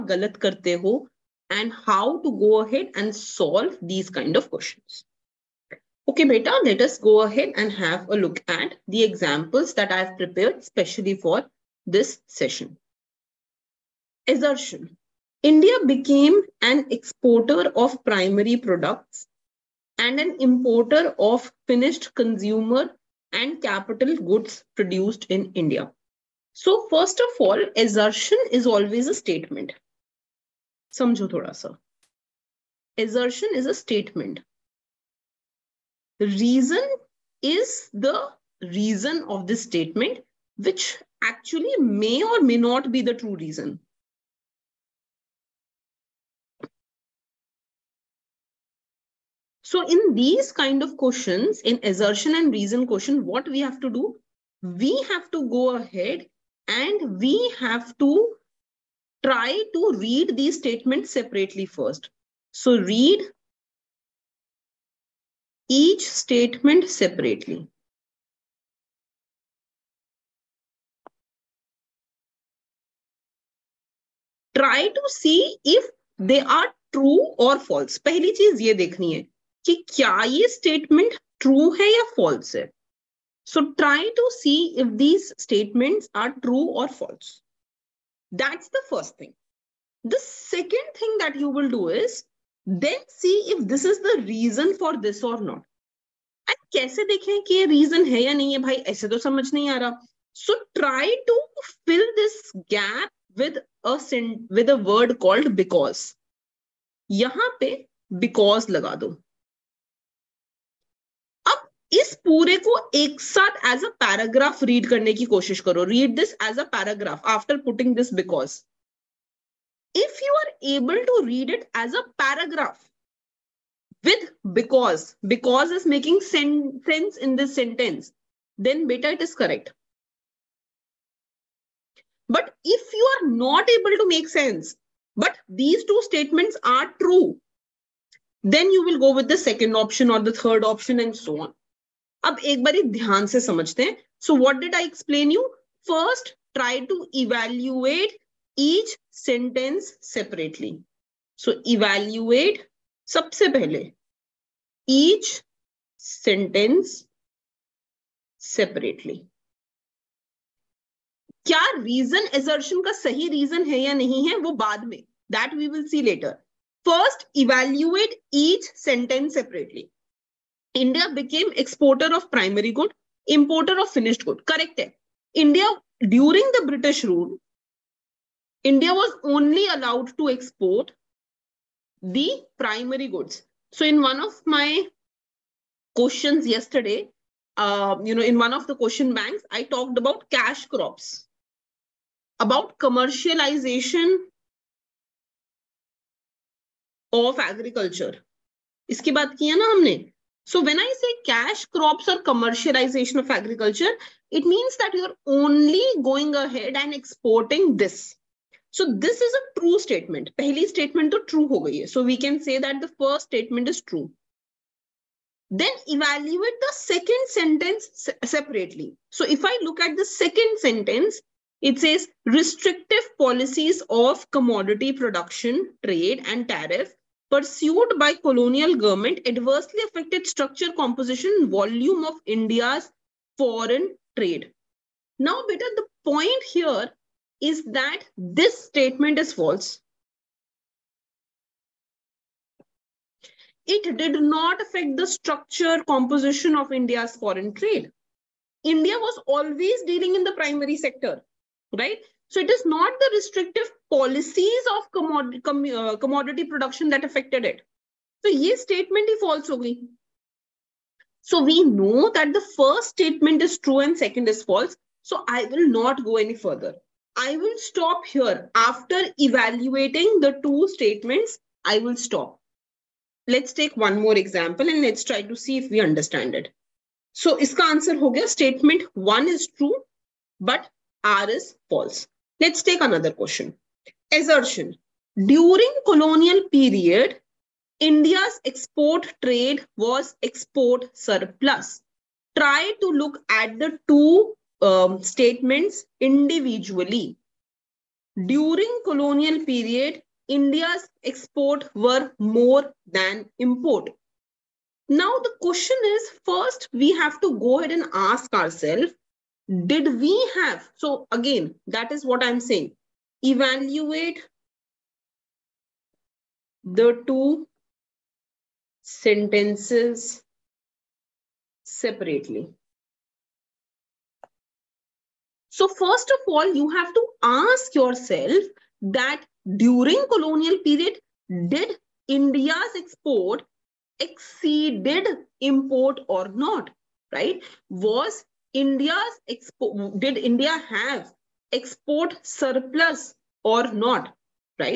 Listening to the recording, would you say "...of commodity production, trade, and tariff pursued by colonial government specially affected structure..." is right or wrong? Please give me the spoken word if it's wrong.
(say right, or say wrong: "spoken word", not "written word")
wrong: "adversely", not "specially".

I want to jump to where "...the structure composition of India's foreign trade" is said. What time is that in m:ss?
4:04.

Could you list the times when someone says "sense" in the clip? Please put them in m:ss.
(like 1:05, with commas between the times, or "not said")
2:06, 2:14.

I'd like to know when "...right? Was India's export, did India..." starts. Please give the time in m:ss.
5:37.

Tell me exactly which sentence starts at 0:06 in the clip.
Okay, beta, let us go ahead and have a look at the examples that I've prepared specially for this session.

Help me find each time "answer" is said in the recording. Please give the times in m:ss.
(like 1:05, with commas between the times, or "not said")
4:37.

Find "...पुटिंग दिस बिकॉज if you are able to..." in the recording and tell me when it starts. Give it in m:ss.
1:57.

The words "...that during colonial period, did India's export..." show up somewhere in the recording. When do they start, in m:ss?
5:28.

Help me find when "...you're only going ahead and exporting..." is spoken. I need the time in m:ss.
3:24.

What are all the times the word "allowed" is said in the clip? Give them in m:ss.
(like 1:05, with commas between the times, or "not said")
2:59.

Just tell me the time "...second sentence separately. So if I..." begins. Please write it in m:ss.
3:36.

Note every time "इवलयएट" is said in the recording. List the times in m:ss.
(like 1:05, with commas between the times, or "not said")
2:27, 2:31, 2:47.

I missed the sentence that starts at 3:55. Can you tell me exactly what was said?
Now, better the point here is that this statement is false.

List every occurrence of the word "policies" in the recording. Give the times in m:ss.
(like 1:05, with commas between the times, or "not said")
3:43, 4:13.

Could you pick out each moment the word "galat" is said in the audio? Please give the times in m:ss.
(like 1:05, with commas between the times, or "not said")
0:00.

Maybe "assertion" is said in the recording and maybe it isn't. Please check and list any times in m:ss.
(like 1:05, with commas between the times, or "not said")
0:14, 0:27, 0:33, 0:51, 4:44.